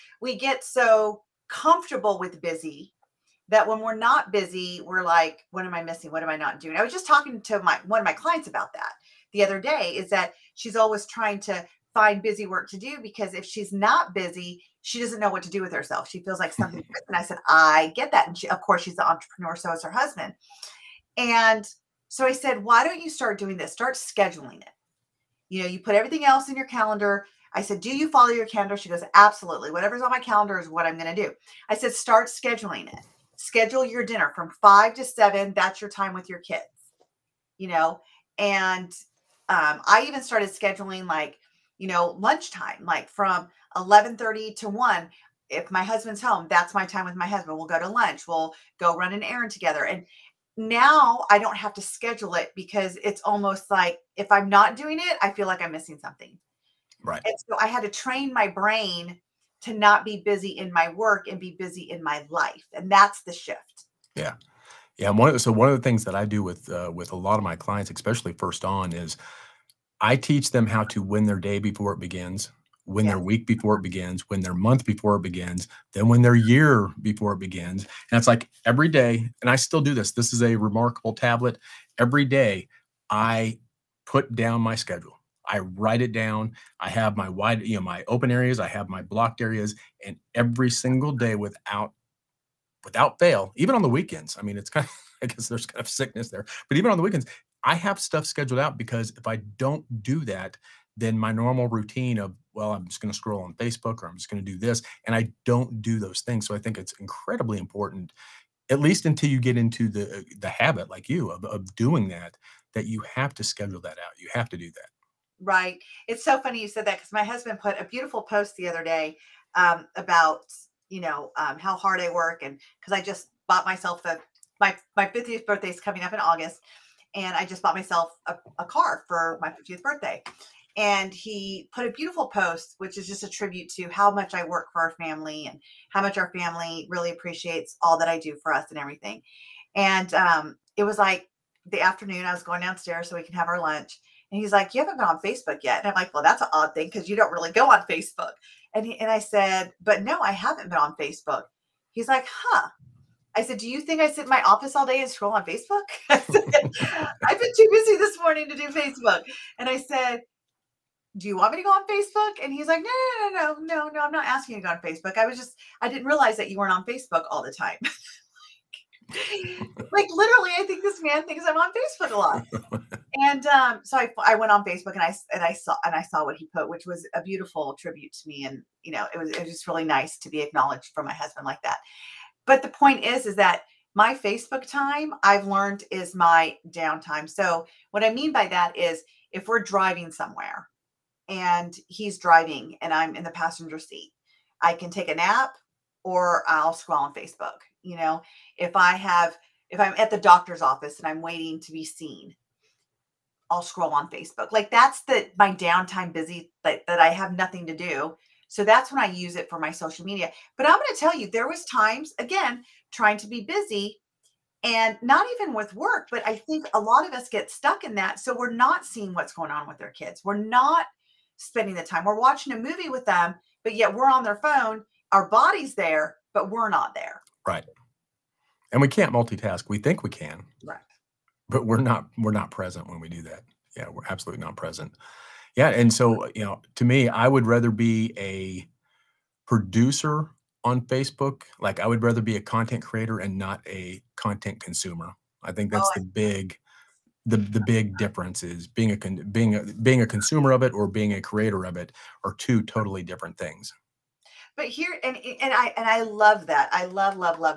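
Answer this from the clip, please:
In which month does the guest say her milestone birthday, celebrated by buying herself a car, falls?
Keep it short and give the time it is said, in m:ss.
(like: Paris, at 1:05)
August, at 2:06.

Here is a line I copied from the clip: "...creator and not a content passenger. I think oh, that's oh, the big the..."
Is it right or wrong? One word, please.
wrong.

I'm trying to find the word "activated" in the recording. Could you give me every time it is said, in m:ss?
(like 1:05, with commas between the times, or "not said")
not said.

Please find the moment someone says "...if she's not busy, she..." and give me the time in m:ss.
0:13.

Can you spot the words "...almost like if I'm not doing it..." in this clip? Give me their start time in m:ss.
0:53.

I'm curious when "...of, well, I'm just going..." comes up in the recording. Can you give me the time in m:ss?
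1:42.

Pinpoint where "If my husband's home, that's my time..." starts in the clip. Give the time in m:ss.
0:45.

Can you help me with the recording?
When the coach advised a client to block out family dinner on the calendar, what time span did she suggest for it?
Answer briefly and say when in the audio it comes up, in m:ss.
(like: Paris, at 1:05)
5 to 7, at 0:34.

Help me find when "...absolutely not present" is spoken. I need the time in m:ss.
3:54.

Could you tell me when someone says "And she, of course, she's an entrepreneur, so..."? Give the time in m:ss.
0:18.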